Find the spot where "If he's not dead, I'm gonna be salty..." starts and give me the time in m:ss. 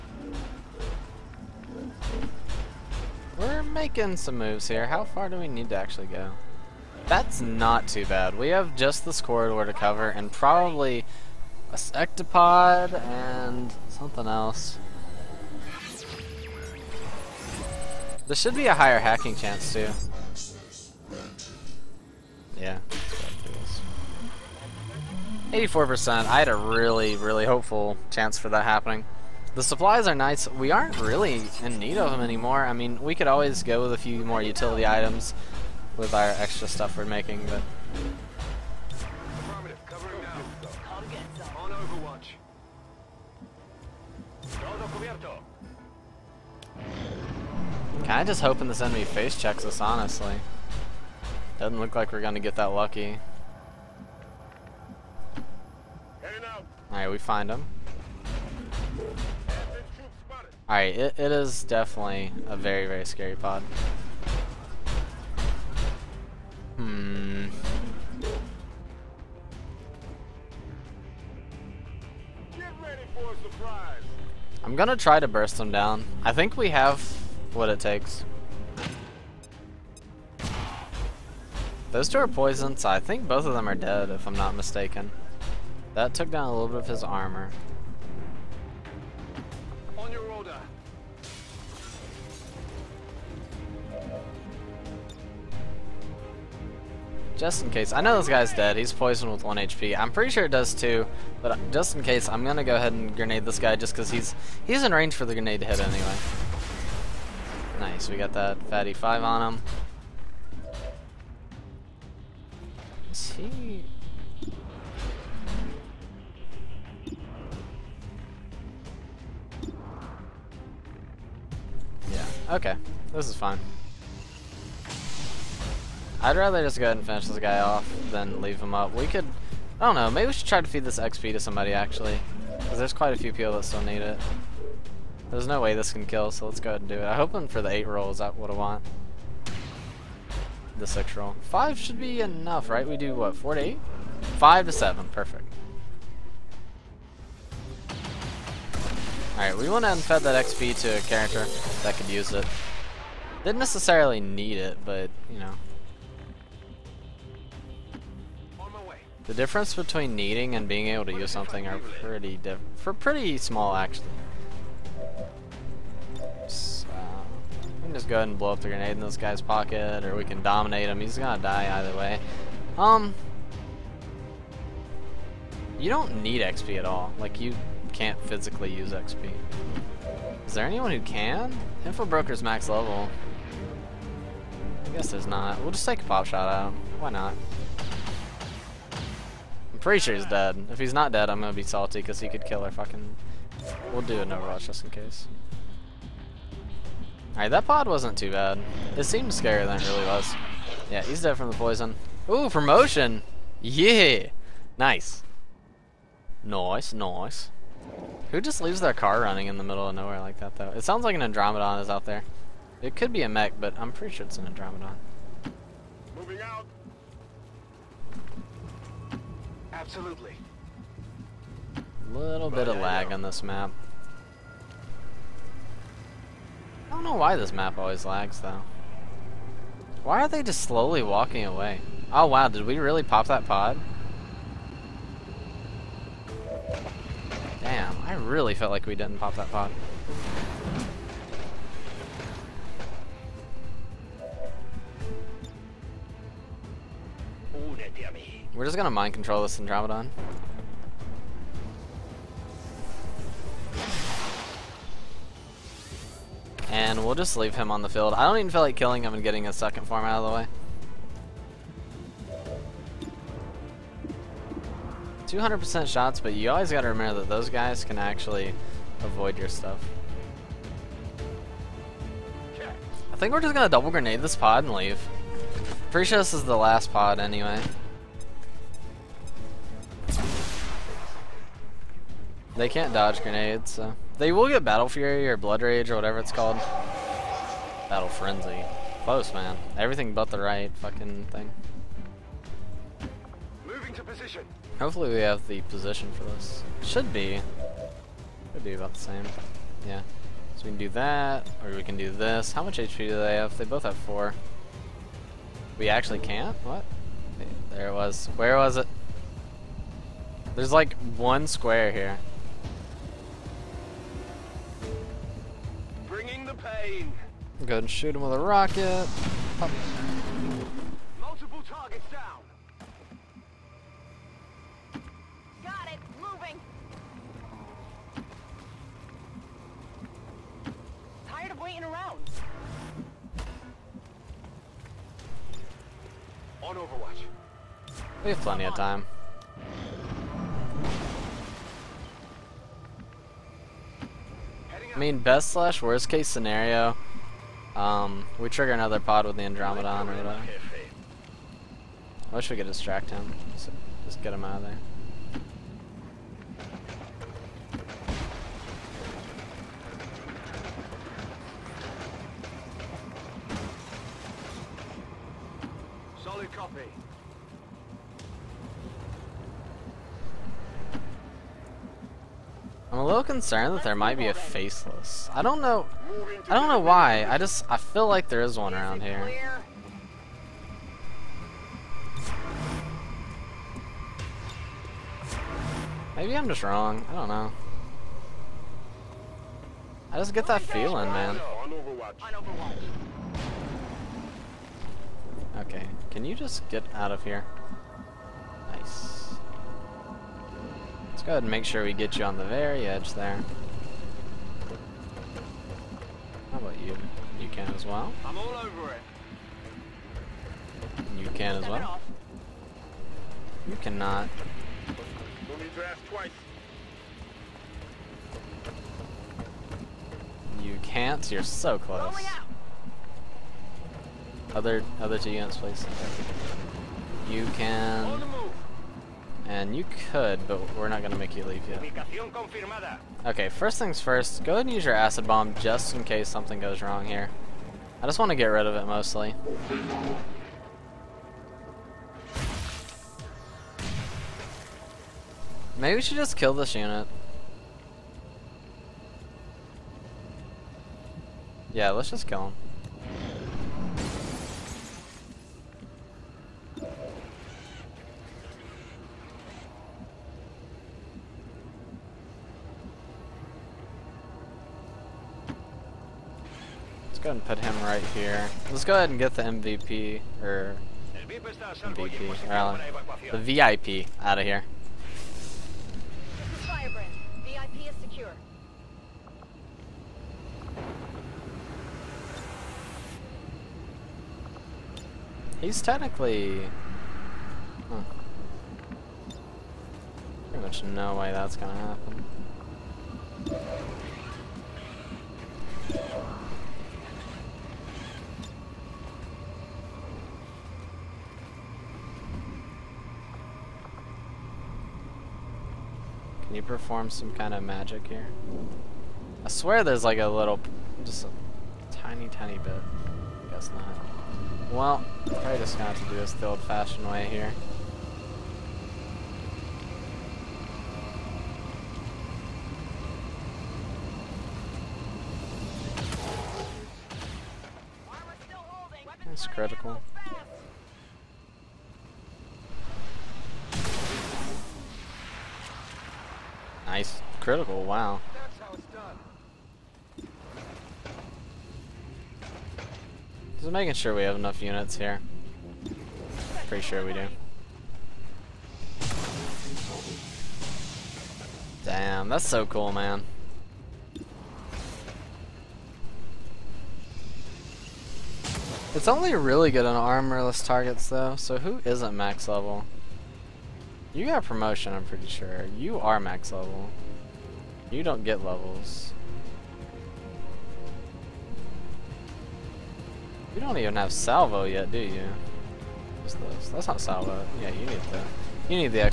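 3:10.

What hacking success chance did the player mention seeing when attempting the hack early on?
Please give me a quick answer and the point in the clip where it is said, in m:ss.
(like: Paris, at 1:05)
84%, at 0:25.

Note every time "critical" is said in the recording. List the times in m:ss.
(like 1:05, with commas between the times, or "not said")
8:49, 8:57.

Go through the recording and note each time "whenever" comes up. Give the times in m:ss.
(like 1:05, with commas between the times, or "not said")
not said.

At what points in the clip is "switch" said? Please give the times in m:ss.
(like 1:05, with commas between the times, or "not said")
not said.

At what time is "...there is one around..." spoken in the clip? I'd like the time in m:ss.
6:18.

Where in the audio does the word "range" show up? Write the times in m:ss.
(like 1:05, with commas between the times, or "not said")
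1:44.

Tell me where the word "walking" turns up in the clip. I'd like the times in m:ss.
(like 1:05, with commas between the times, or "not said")
3:51.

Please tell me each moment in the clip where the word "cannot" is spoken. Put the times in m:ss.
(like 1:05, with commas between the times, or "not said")
6:53.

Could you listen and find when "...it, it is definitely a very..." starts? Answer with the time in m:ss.
1:00.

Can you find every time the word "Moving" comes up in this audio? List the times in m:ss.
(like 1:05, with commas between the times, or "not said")
3:36, 4:53, 5:26.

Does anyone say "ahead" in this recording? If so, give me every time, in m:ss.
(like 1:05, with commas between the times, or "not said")
1:42, 2:06, 2:16, 2:48, 5:17, 6:41, 7:14, 7:48.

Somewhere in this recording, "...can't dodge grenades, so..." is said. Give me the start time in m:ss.
4:42.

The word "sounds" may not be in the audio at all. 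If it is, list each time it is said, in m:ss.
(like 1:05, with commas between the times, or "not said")
3:30.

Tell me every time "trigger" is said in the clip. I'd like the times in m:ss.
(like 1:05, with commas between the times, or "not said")
5:48.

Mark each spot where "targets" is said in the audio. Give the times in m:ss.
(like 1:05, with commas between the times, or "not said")
5:21, 9:20.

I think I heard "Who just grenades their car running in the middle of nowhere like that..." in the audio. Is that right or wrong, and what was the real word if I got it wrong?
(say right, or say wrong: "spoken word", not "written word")
wrong: "leaves", not "grenades".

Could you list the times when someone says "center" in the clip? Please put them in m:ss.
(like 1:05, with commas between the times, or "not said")
not said.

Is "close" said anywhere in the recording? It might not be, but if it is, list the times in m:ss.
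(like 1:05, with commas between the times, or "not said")
4:49, 7:01.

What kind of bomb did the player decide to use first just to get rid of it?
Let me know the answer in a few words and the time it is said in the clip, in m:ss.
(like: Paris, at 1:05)
Acid bomb, at 7:14.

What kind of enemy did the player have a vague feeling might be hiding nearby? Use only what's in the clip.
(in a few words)
Faceless.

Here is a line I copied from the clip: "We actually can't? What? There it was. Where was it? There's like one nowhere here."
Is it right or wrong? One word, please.
wrong.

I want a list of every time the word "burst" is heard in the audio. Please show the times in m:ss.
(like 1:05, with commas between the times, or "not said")
1:15.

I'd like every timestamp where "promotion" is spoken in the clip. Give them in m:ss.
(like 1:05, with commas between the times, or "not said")
3:22, 9:24.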